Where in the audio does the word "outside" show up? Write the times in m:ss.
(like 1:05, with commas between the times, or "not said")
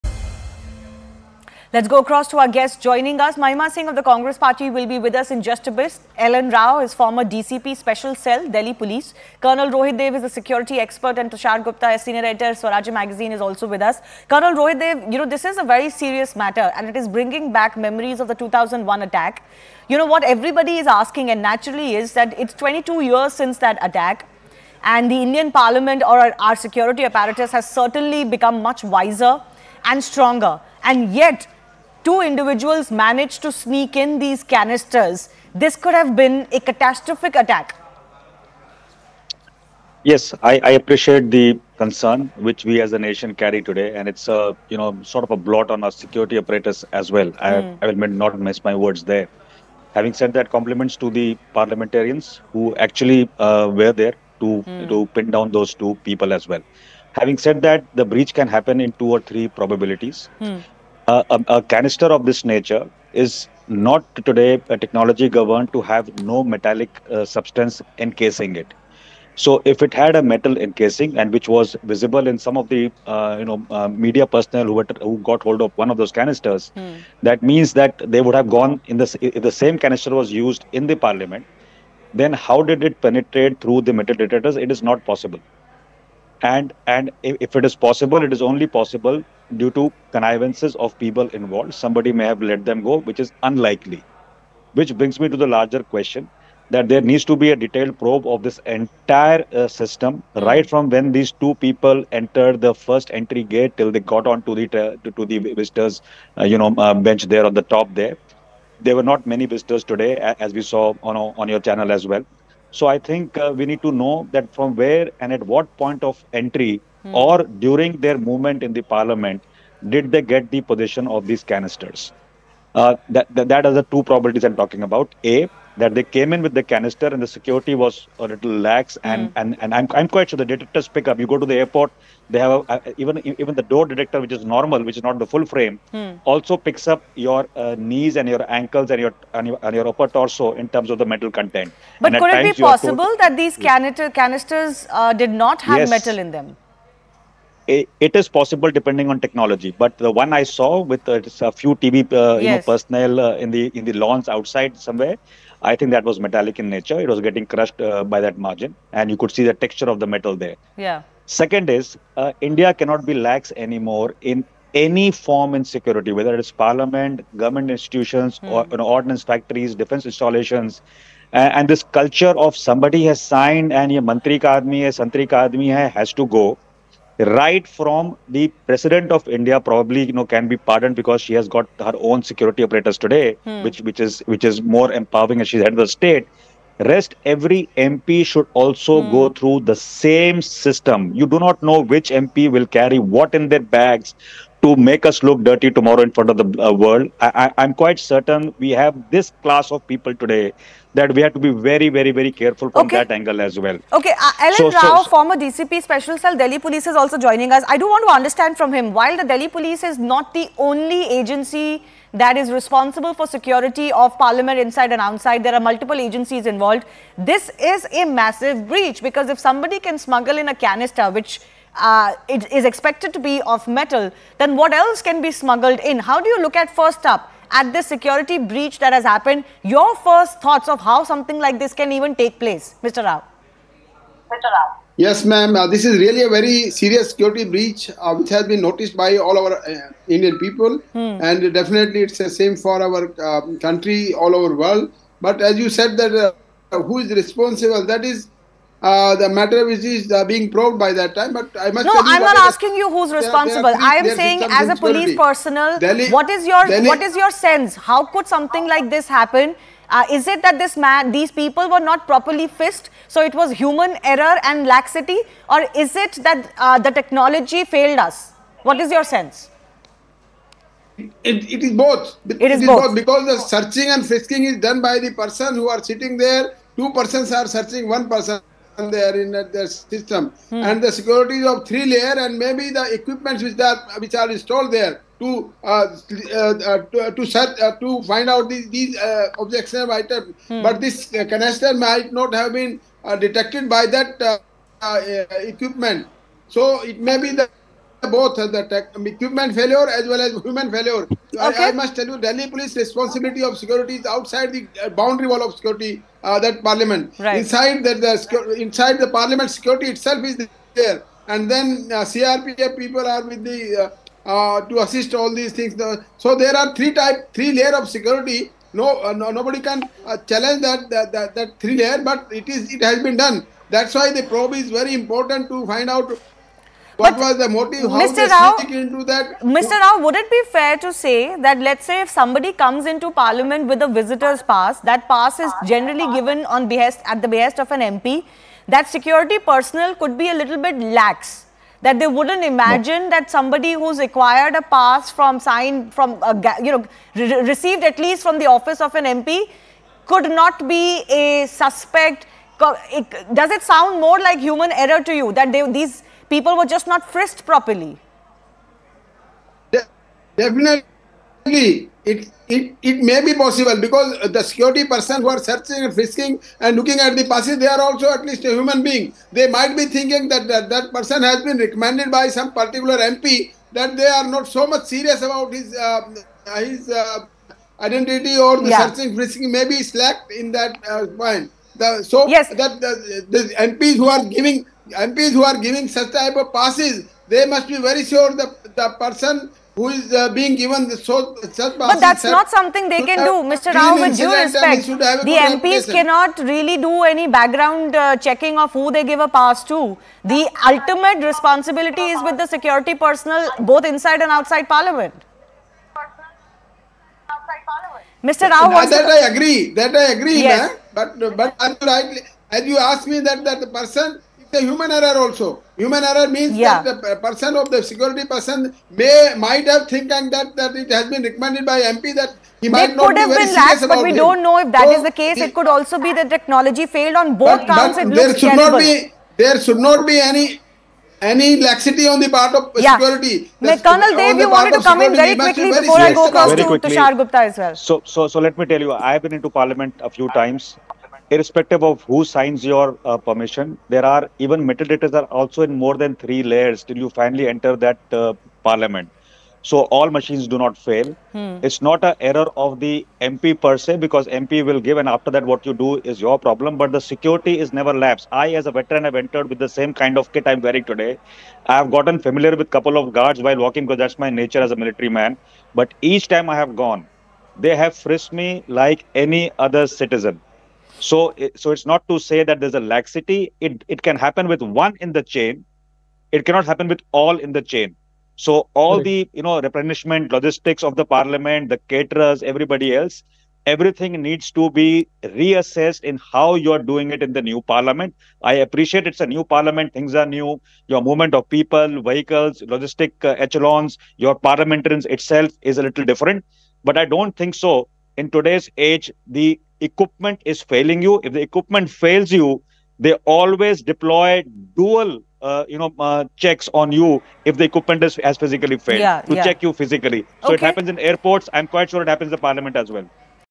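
2:34, 3:35, 5:04, 6:44.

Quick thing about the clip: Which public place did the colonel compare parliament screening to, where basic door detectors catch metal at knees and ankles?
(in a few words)
airport.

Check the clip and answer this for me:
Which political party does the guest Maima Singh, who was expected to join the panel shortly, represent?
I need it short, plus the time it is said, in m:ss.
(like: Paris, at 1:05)
Congress Party, at 0:04.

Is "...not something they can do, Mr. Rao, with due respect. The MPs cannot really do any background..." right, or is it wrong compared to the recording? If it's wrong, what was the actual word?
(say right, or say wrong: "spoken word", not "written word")
right.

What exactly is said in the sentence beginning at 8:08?
I appreciate it's a new parliament; things are new.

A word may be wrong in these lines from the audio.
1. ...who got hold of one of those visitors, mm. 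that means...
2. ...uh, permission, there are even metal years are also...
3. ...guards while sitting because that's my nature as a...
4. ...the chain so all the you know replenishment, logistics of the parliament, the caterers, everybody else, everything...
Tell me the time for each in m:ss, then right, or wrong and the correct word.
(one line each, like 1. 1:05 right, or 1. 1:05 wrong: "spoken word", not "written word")
1. 1:15 wrong: "canisters", not "visitors"
2. 7:23 wrong: "detectors", not "years"
3. 7:43 wrong: "walking", not "sitting"
4. 7:57 right.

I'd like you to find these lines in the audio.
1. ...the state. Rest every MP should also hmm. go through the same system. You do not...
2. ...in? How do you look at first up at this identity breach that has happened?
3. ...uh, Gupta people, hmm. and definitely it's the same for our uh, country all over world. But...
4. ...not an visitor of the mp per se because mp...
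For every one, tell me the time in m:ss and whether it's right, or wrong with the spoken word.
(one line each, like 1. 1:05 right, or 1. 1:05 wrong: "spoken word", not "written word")
1. 3:05 right
2. 3:45 wrong: "security", not "identity"
3. 3:59 wrong: "Indian", not "Gupta"
4. 7:31 wrong: "error", not "visitor".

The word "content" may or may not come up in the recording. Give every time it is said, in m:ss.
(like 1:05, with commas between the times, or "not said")
2:21.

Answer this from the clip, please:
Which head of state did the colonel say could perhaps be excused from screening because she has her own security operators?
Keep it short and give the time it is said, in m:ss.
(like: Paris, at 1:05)
President of India, at 2:58.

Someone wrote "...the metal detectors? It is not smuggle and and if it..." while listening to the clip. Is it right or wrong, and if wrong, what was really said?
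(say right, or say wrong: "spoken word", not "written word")
wrong: "possible", not "smuggle".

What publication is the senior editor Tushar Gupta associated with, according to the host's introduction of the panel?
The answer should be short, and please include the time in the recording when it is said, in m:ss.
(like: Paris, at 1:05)
Swaraj magazine, at 0:12.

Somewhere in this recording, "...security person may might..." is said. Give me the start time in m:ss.
6:57.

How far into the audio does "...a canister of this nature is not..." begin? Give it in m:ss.
1:01.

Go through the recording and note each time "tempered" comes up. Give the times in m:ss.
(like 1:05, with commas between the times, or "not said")
not said.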